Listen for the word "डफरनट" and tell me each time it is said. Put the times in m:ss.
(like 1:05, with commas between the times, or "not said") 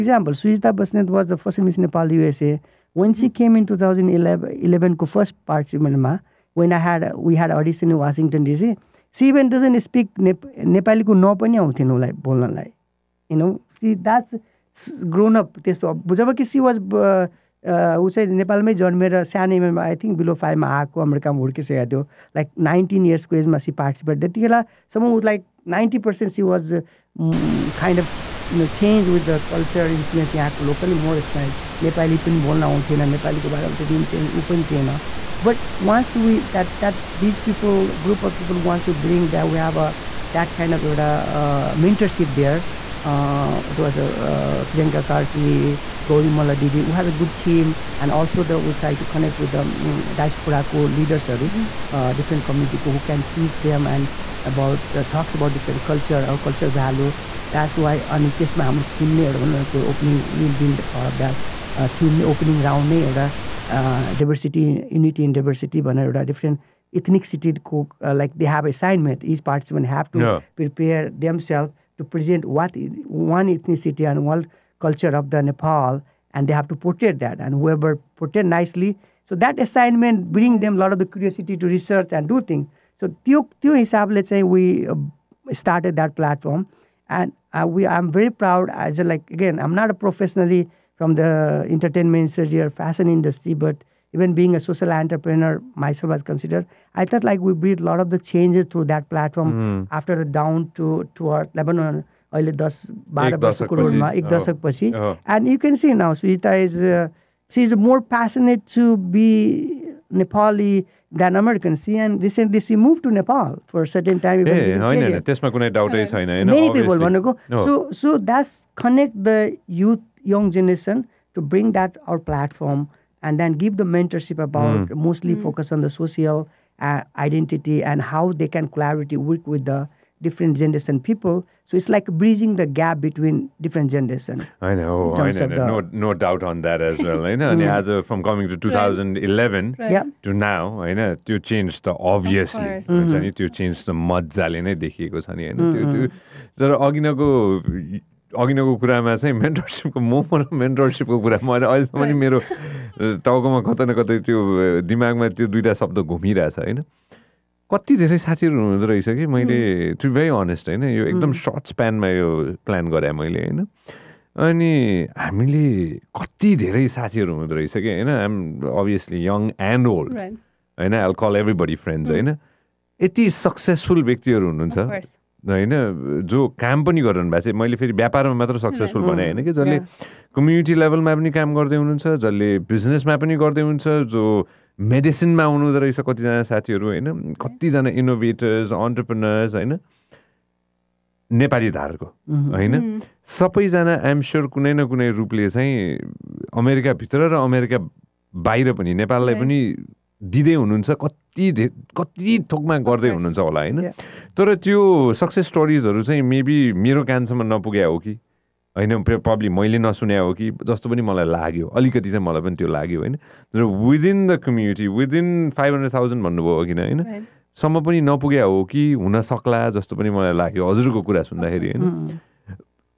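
0:52, 1:06.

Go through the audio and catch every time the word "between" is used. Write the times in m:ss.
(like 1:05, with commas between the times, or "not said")
2:13.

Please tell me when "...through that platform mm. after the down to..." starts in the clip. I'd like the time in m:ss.
1:38.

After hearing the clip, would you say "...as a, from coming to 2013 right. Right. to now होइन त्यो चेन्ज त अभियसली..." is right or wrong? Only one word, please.
wrong.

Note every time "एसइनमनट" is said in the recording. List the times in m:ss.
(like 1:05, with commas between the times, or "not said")
1:08, 1:19.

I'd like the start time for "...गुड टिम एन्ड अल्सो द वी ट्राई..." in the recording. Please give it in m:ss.
0:47.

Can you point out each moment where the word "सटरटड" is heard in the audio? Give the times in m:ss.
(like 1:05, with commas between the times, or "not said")
1:25.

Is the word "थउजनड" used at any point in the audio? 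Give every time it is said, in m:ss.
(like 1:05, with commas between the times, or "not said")
0:03, 3:35.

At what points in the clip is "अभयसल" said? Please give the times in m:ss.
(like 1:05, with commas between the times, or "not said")
2:22, 2:48.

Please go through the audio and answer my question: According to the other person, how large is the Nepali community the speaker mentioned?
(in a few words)
500,000.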